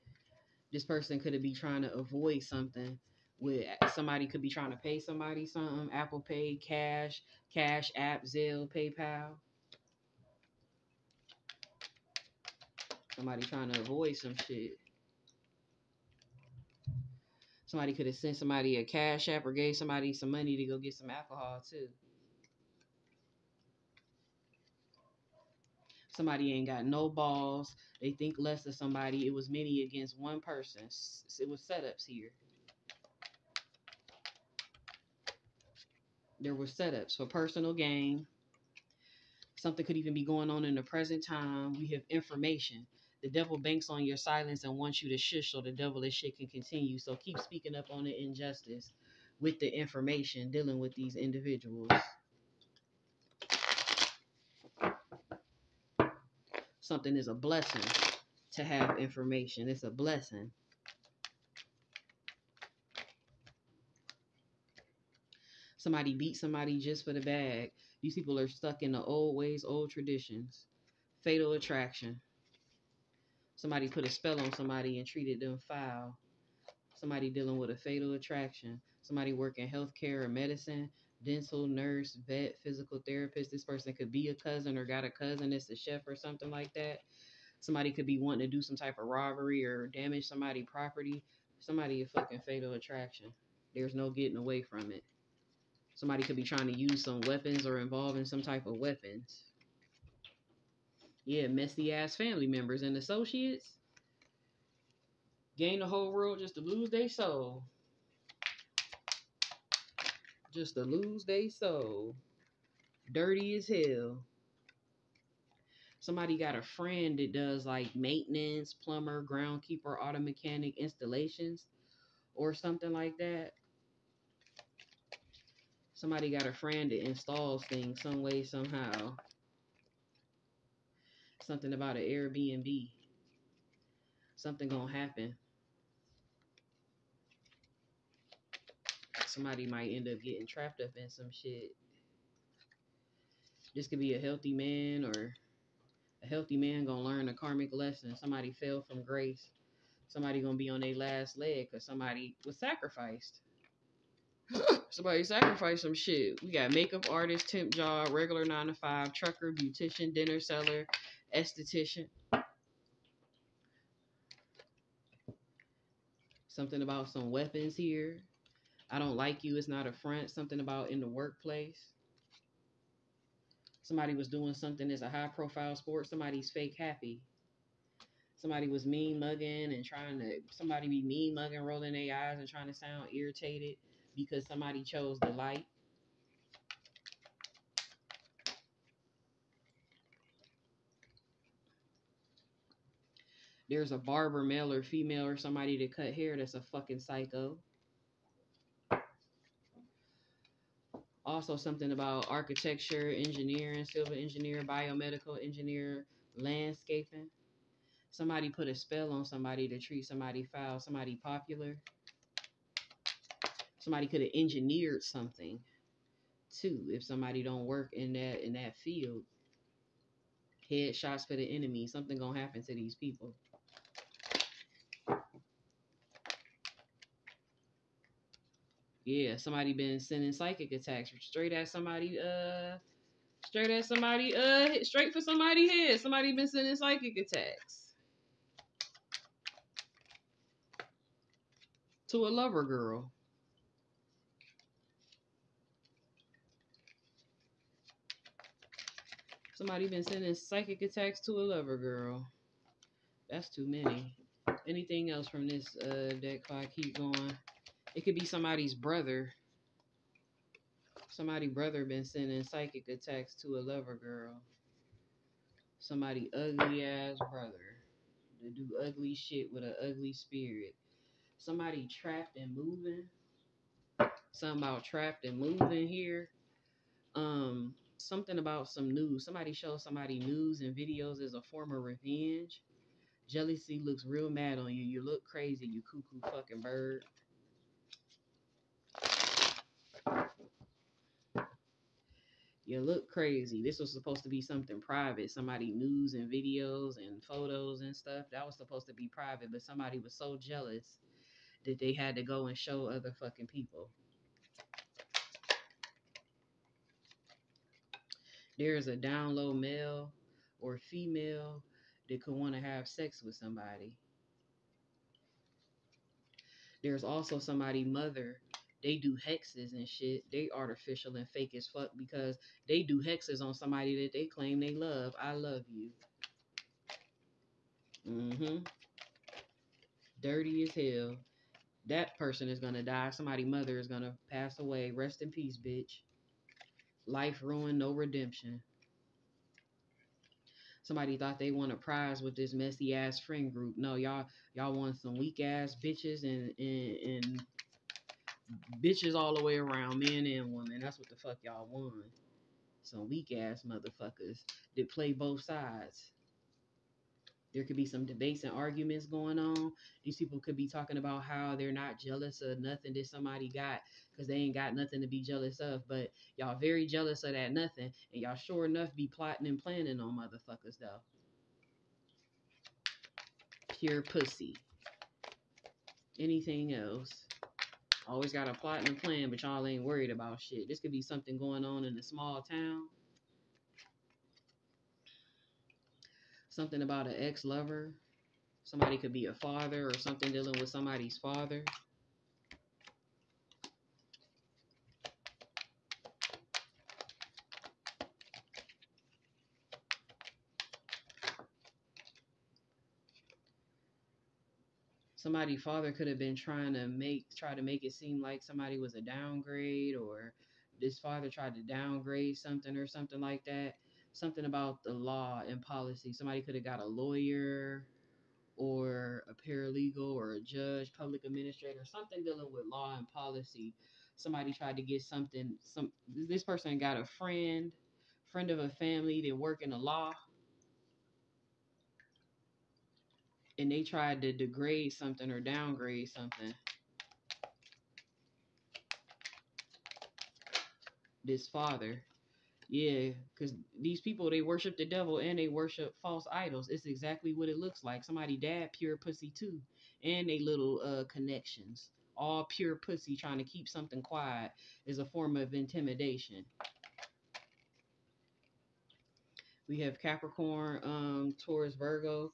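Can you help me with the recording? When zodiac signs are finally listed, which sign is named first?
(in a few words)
Capricorn.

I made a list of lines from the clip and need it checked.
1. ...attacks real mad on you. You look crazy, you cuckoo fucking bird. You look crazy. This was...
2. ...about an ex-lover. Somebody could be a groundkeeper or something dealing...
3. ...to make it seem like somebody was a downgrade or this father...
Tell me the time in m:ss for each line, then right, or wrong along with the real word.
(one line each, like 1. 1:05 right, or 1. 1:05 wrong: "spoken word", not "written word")
1. 4:43 wrong: "looks", not "attacks"
2. 6:26 wrong: "father", not "groundkeeper"
3. 6:47 right.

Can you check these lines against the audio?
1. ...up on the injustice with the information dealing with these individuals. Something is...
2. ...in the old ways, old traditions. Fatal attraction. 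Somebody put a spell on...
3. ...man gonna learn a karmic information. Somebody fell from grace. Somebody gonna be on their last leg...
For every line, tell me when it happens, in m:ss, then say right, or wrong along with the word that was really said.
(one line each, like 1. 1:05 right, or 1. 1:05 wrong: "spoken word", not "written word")
1. 0:47 right
2. 1:08 right
3. 2:26 wrong: "lesson", not "information".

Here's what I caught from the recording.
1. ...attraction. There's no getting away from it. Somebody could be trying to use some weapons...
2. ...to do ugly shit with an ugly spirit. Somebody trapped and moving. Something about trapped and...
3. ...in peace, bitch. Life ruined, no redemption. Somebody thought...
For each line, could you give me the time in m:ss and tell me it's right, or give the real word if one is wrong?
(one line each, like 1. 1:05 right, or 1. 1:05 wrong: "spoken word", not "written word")
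1. 1:32 right
2. 4:28 right
3. 5:35 right.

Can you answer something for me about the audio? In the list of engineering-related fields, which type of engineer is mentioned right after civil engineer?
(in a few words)
Biomedical engineer.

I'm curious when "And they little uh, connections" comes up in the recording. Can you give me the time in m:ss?
7:30.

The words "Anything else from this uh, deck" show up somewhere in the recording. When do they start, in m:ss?
4:14.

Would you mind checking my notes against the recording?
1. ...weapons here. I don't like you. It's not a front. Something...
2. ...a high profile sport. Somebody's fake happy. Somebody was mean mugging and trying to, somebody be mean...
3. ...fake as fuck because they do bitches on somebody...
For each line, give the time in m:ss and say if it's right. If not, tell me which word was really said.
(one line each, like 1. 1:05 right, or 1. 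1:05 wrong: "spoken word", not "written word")
1. 2:47 right
2. 2:55 right
3. 5:21 wrong: "hexes", not "bitches".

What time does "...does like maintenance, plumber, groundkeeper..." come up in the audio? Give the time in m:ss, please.
1:57.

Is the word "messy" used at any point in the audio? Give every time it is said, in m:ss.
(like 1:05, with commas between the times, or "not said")
1:41, 5:42.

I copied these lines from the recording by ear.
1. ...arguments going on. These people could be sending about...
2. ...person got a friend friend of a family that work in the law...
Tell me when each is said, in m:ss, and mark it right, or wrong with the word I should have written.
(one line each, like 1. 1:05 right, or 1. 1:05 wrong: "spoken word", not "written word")
1. 5:58 wrong: "talking", not "sending"
2. 7:06 right.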